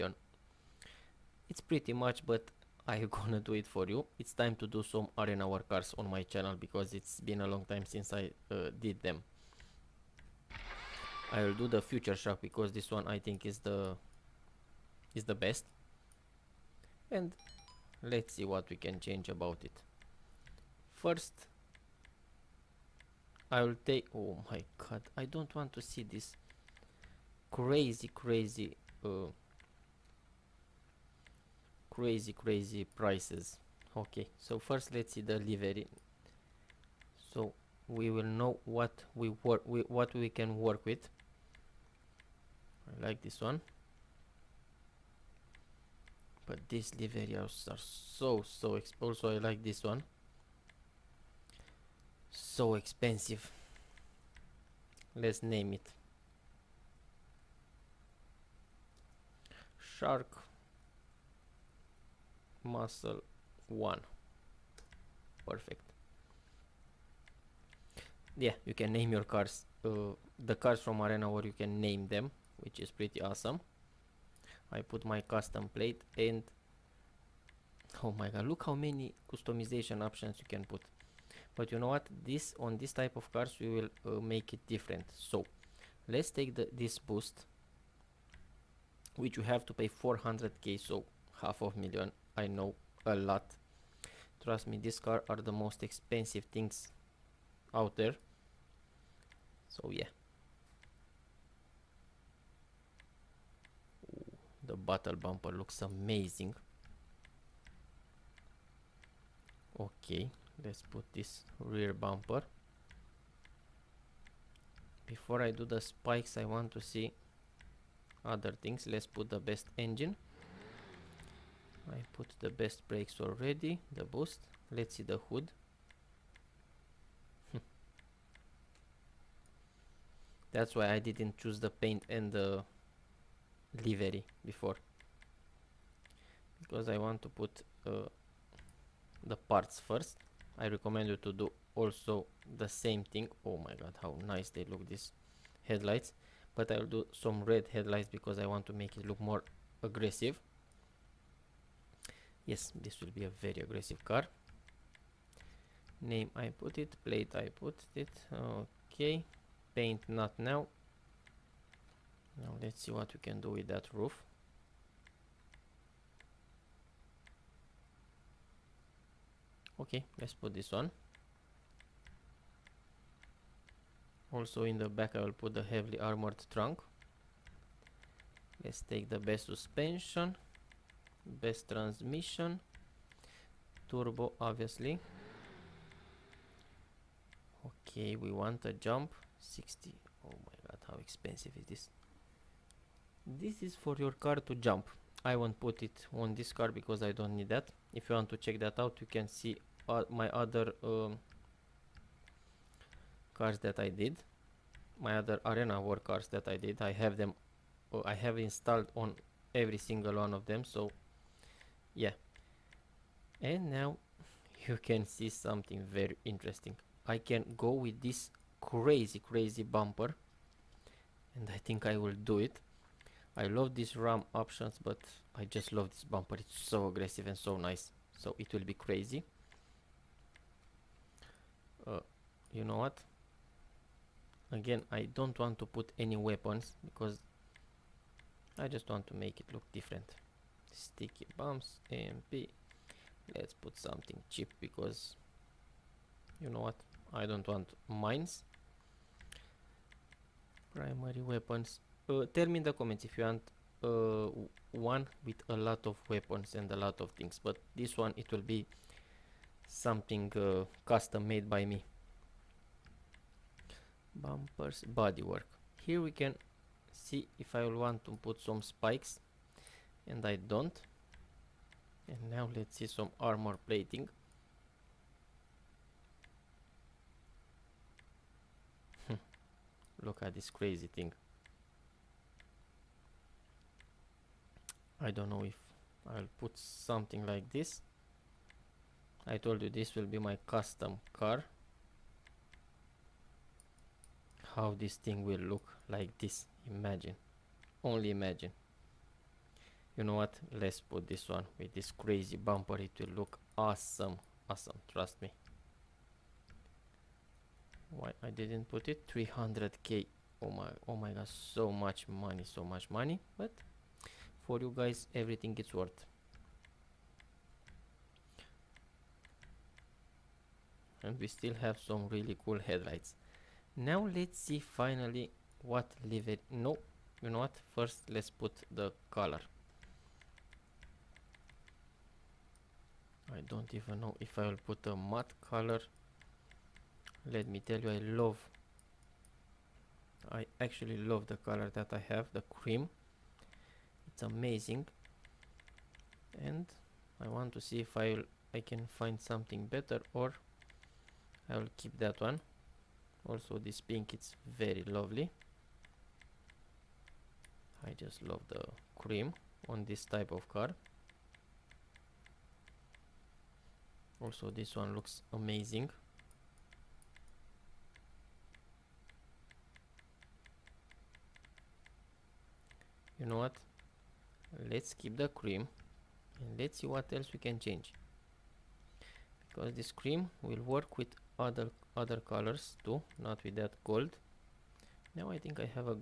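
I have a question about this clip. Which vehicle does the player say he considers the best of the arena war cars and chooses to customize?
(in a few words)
Future Shock.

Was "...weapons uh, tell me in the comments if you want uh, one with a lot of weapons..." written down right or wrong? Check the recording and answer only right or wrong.
right.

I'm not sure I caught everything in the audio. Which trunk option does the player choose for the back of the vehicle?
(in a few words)
Heavily armored trunk.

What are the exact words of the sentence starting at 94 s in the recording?
Trust me, these cars are the most expensive things out there.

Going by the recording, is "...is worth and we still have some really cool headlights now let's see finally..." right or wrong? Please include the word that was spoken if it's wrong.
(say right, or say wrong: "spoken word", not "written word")
right.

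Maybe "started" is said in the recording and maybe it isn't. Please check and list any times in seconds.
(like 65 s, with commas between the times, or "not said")
not said.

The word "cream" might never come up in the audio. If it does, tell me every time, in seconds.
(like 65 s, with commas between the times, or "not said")
342 s, 358 s, 375 s, 379 s.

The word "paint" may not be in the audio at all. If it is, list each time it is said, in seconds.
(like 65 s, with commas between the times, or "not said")
131 s, 159 s.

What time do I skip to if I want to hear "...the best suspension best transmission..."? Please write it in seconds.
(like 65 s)
179 s.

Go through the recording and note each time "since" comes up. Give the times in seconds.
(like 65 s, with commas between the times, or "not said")
7 s.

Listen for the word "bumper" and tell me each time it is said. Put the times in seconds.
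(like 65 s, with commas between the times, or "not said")
105 s, 111 s, 219 s, 226 s, 264 s, 302 s.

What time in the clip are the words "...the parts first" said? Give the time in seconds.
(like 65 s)
139 s.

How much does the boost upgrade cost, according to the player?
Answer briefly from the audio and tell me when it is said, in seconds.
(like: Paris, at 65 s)
400k, at 89 s.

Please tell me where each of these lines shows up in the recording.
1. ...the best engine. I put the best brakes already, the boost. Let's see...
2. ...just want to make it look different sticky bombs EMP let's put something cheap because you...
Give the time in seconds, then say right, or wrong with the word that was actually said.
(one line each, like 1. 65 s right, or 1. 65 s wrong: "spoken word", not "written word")
1. 119 s right
2. 238 s right.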